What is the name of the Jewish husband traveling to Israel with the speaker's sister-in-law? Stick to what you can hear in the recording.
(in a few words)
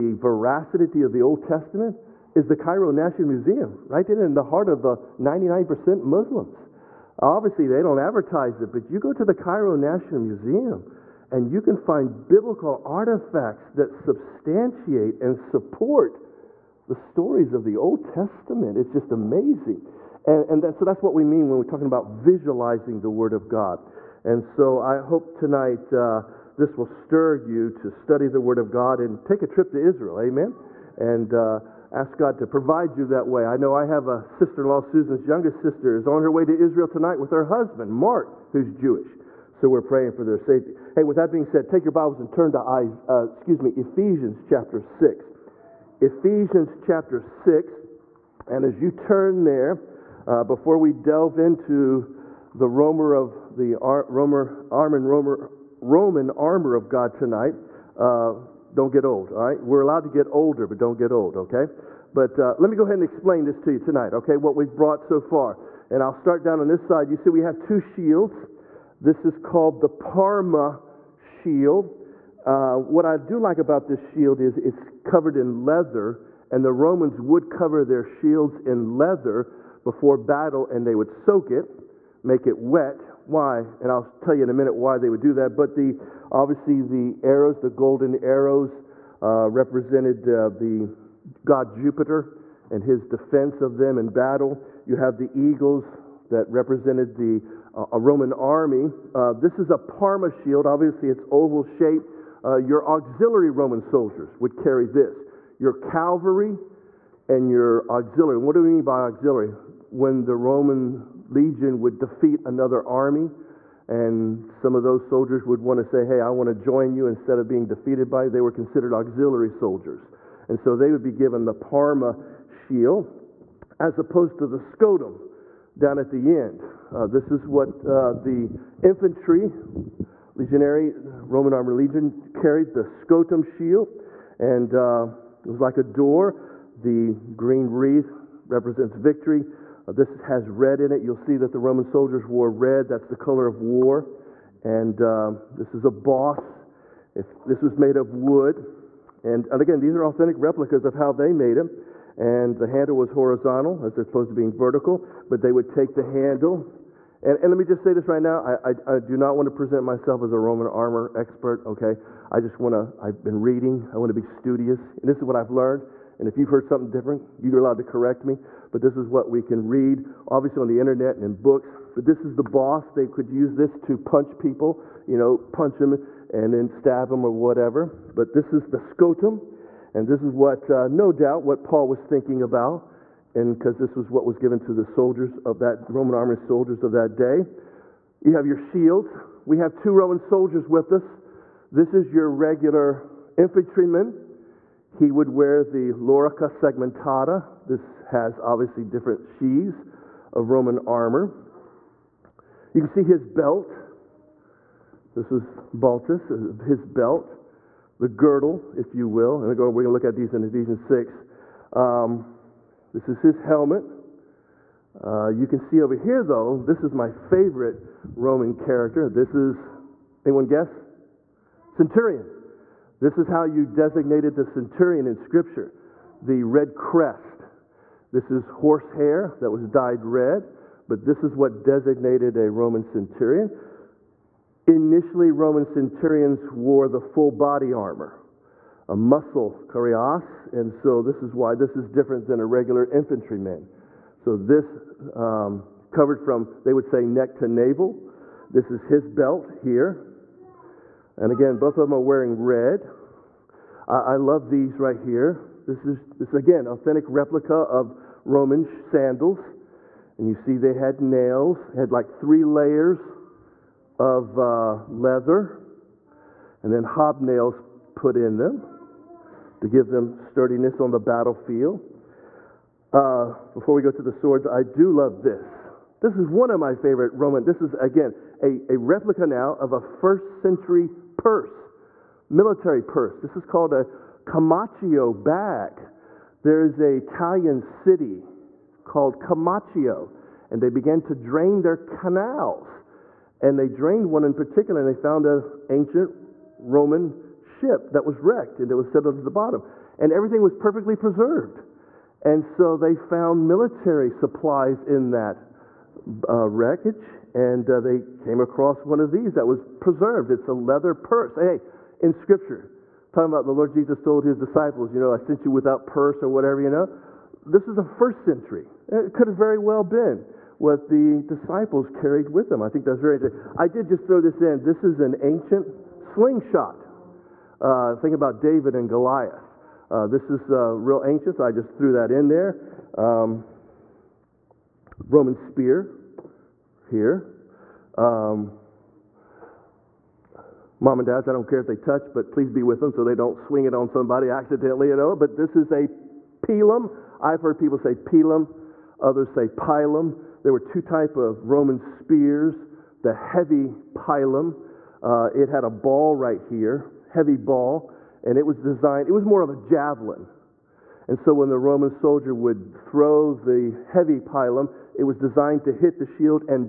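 Mark.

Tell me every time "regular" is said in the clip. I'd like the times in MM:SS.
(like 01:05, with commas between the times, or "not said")
03:12, 04:02.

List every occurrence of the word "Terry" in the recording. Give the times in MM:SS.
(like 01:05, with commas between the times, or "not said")
not said.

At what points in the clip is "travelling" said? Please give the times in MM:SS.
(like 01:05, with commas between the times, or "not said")
not said.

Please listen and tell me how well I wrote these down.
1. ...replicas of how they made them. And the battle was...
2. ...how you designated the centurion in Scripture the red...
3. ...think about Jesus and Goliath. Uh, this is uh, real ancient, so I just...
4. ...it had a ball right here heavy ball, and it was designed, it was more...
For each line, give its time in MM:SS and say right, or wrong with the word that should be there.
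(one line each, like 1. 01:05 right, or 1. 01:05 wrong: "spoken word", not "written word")
1. 02:30 wrong: "handle", not "battle"
2. 03:43 right
3. 05:27 wrong: "David", not "Jesus"
4. 05:55 right.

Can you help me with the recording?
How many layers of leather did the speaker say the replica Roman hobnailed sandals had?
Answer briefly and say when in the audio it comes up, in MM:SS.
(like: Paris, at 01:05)
3, at 04:22.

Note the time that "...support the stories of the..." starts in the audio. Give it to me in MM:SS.
00:15.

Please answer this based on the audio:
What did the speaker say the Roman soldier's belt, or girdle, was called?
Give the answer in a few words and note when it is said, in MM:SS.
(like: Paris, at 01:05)
Baltus, at 03:25.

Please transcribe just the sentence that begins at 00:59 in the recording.
We're allowed to get older, but don't get old, okay?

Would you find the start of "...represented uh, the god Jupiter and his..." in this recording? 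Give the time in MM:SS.
01:29.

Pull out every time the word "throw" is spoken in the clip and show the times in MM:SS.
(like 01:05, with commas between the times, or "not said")
05:24, 06:02.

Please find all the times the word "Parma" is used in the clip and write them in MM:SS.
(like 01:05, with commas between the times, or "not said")
01:09, 01:39, 02:01.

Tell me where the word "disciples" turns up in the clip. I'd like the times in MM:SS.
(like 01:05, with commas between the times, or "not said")
05:14, 05:21.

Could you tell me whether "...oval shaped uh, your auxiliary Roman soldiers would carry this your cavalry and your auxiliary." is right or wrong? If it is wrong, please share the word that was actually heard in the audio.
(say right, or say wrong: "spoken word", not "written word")
right.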